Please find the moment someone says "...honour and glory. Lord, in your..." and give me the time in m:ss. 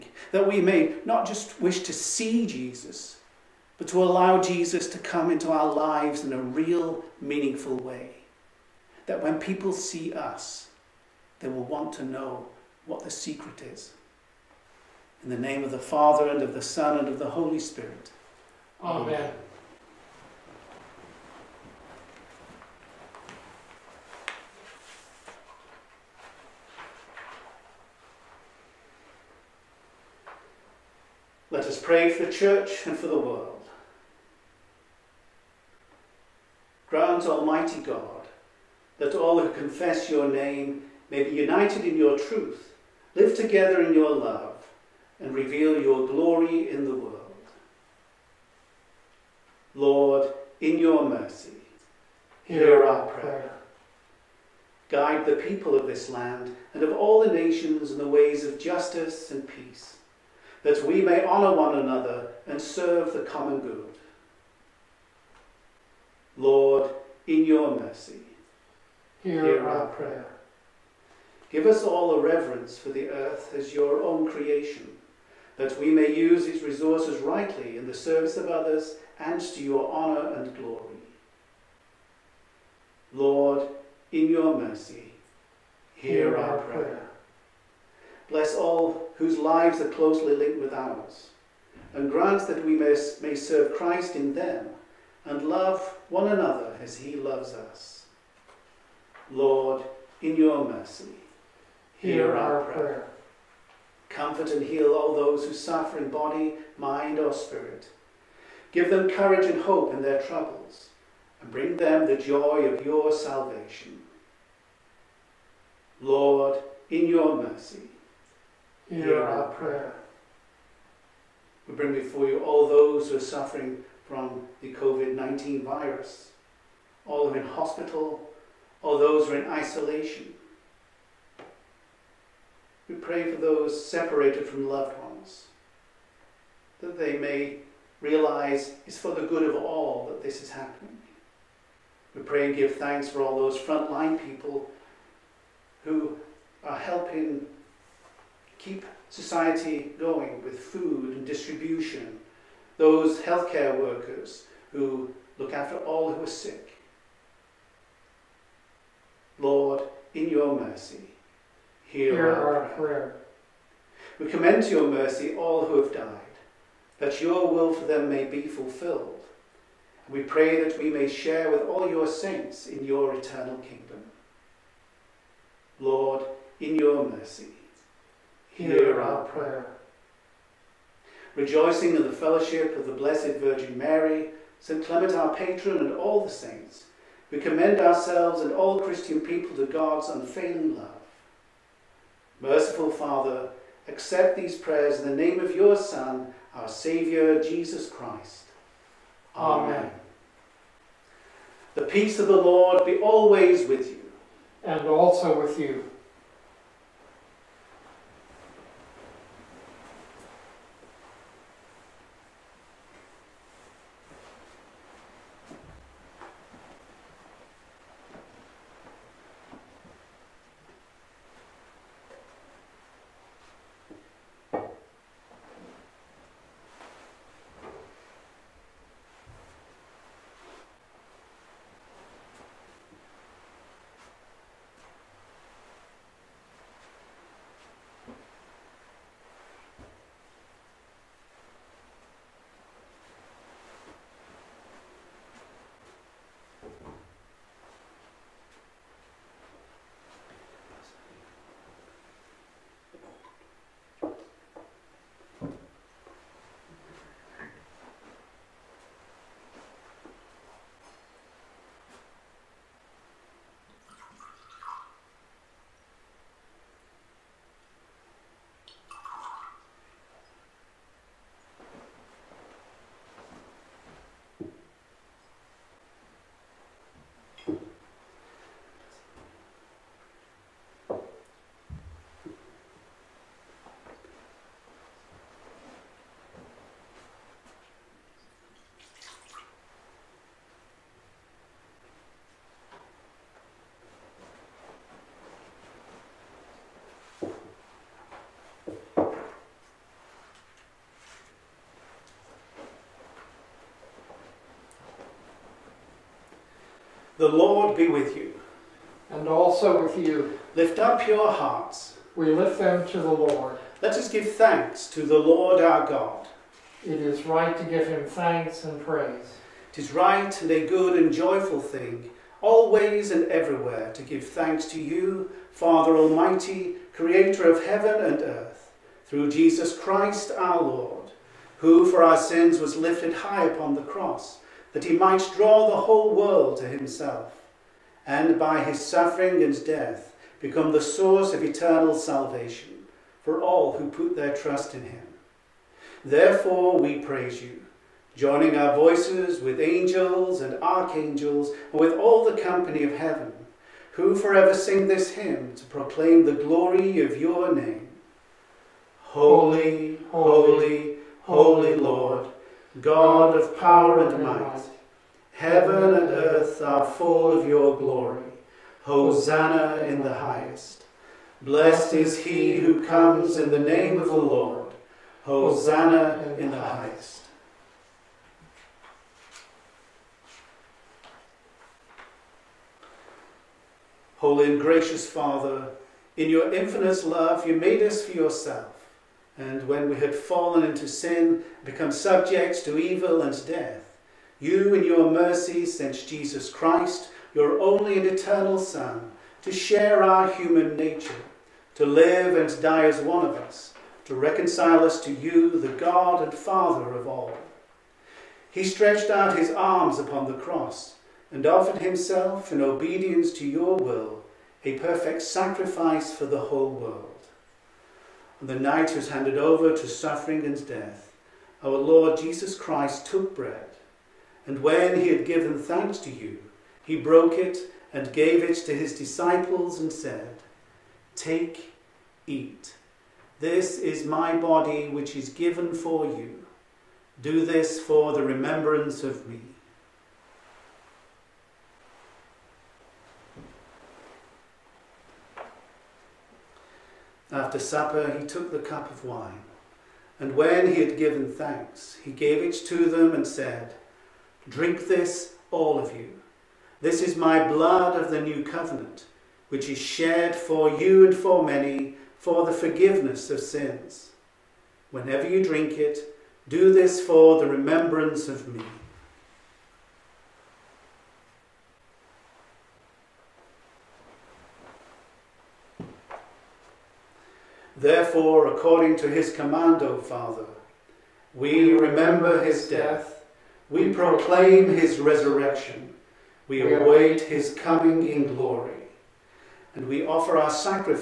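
1:19.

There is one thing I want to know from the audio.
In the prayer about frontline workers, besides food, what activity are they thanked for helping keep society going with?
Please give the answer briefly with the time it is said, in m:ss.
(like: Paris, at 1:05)
distribution, at 2:31.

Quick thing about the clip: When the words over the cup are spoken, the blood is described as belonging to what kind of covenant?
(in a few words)
new covenant.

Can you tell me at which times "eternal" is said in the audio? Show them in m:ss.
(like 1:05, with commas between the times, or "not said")
2:53, 5:41, 6:38.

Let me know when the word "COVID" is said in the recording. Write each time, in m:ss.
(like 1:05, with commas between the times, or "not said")
2:04.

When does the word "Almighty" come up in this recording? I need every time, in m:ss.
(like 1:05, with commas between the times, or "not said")
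0:37, 5:25.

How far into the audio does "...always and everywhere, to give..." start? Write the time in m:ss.
5:22.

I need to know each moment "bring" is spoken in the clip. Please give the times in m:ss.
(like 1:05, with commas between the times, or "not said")
1:51, 2:01.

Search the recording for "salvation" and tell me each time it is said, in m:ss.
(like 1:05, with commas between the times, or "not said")
1:53, 5:41.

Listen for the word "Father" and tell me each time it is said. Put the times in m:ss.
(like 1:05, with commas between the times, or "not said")
0:15, 3:12, 5:25, 6:25, 6:46, 7:59.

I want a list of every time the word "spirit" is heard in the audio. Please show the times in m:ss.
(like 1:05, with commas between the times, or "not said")
0:17, 1:47.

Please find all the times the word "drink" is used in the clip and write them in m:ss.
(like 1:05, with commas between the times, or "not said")
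7:34, 7:45.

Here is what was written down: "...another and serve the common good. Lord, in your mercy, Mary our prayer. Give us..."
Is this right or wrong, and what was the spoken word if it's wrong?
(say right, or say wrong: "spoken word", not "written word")
wrong: "Hear", not "Mary".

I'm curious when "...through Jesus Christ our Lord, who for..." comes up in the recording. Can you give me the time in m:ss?
5:29.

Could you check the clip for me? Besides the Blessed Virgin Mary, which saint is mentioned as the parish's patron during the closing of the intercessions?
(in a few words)
St. Clement.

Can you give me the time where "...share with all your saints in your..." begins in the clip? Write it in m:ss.
2:51.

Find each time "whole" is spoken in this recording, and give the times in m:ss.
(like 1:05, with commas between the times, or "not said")
5:35, 6:56.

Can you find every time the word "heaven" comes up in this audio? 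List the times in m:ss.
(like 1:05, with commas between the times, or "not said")
5:27, 5:52, 6:05.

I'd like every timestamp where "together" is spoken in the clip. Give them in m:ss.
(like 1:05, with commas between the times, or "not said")
0:43.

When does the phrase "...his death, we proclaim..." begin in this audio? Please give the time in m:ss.
8:02.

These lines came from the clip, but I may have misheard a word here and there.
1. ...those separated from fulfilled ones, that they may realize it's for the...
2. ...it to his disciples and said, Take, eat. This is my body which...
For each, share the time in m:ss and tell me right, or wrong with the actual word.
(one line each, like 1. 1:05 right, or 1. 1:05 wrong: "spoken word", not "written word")
1. 2:13 wrong: "loved", not "fulfilled"
2. 7:08 right.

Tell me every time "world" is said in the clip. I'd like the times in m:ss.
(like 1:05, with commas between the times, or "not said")
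0:33, 0:46, 5:36, 6:56.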